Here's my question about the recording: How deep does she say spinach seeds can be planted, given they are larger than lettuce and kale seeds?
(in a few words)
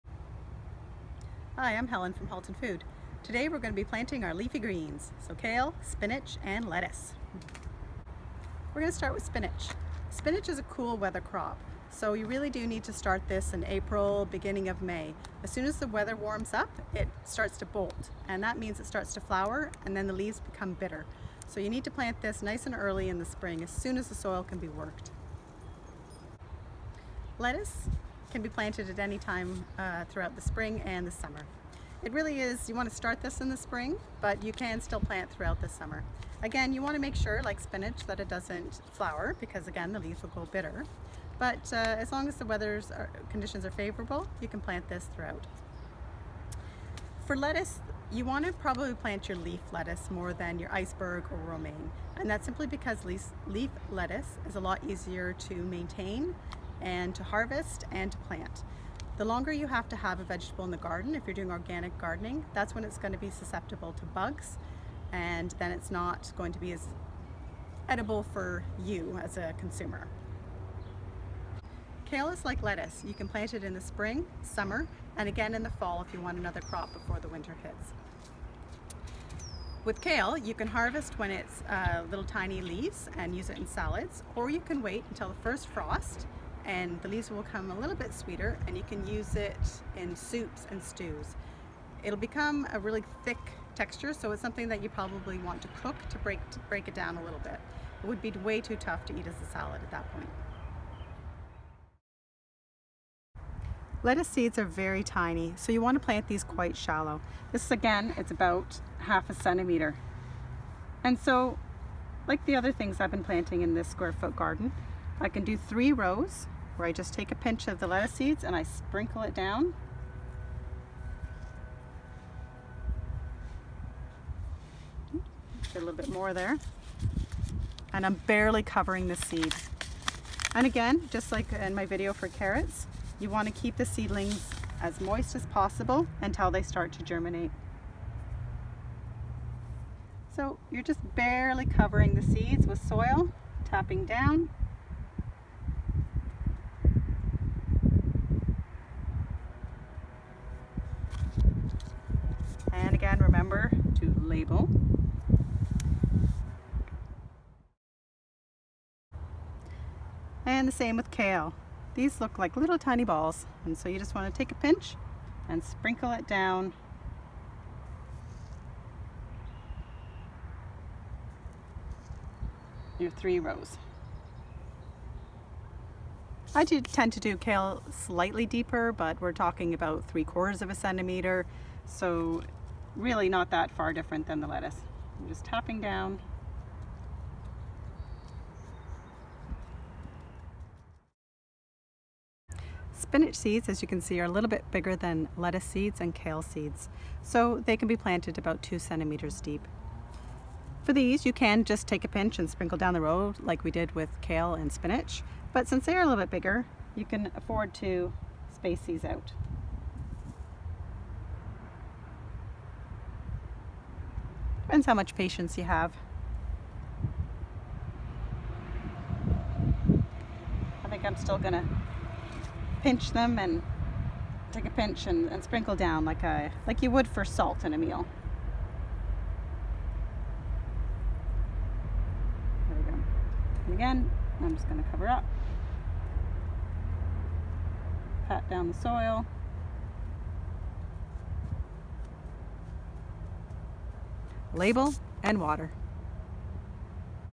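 2 centimeters.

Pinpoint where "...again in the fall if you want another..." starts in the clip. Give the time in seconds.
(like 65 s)
75 s.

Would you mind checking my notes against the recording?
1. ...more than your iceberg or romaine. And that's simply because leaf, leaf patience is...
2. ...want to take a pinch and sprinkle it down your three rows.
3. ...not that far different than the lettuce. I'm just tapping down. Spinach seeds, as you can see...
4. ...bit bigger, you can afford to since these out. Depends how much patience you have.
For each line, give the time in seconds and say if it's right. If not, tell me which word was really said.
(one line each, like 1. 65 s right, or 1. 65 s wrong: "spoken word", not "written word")
1. 50 s wrong: "lettuce", not "patience"
2. 164 s right
3. 183 s right
4. 206 s wrong: "space", not "since".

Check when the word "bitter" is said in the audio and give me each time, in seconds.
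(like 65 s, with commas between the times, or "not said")
20 s, 40 s.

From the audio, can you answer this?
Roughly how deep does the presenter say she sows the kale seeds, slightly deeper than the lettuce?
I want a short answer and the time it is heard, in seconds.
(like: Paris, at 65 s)
3/4 of a centimeter, at 180 s.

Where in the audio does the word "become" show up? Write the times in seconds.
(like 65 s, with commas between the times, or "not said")
20 s, 92 s.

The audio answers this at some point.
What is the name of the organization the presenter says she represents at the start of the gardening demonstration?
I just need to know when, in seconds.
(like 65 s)
2 s.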